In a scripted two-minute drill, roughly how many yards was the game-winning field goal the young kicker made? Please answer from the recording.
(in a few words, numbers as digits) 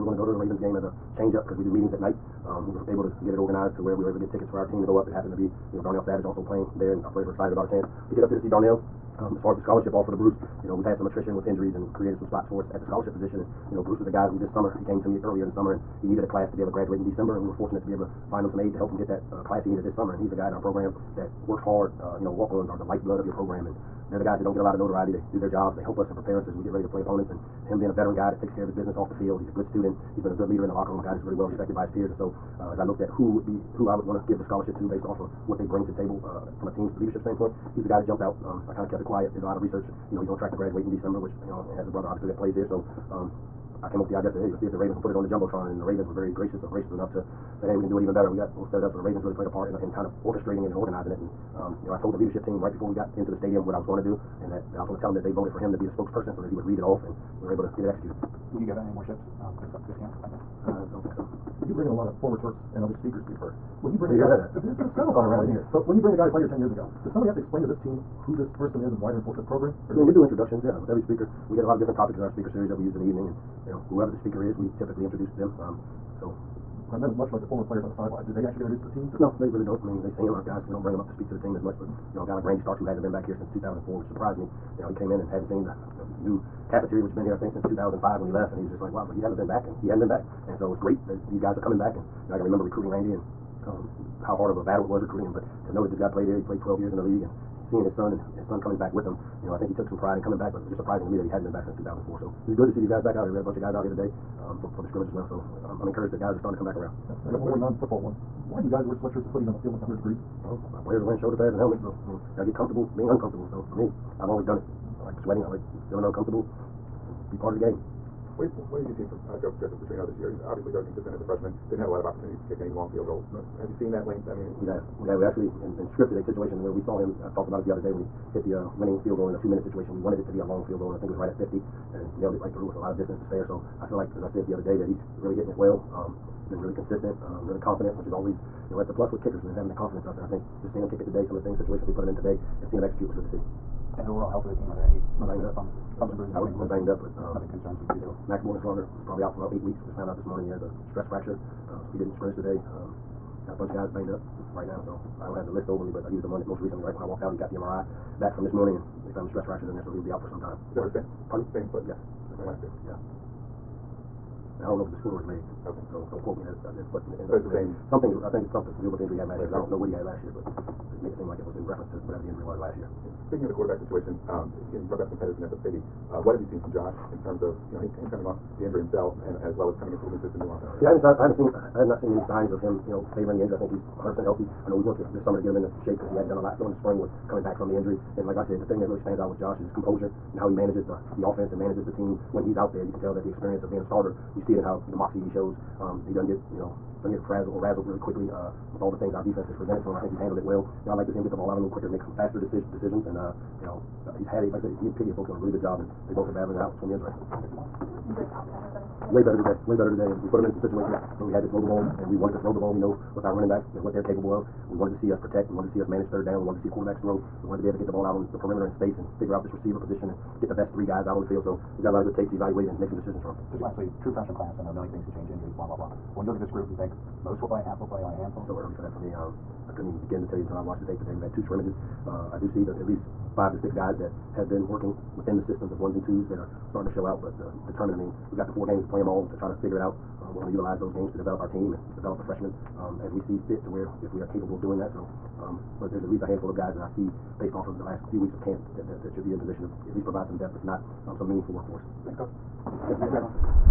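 50.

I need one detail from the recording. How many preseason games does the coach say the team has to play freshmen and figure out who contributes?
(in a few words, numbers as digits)
4.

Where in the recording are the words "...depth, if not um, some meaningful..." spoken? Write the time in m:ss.
4:10.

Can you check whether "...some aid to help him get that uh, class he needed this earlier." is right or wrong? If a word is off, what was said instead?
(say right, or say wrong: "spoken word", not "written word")
wrong: "summer", not "earlier".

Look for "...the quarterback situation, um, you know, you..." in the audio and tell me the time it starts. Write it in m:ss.
2:53.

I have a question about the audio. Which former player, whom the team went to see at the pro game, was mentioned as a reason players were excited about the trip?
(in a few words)
Darnell Savage.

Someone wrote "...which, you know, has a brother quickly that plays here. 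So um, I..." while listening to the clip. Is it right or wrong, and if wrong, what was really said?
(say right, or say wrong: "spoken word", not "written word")
wrong: "obviously", not "quickly".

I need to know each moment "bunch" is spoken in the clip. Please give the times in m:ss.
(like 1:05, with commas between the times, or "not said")
1:43, 2:33.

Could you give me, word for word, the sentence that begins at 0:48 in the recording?
So the Ravens really played a part in, in kind of orchestrating it and organizing it.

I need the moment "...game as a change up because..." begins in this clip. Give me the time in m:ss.
0:00.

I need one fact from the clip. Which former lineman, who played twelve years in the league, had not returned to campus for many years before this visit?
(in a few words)
Randy Starks.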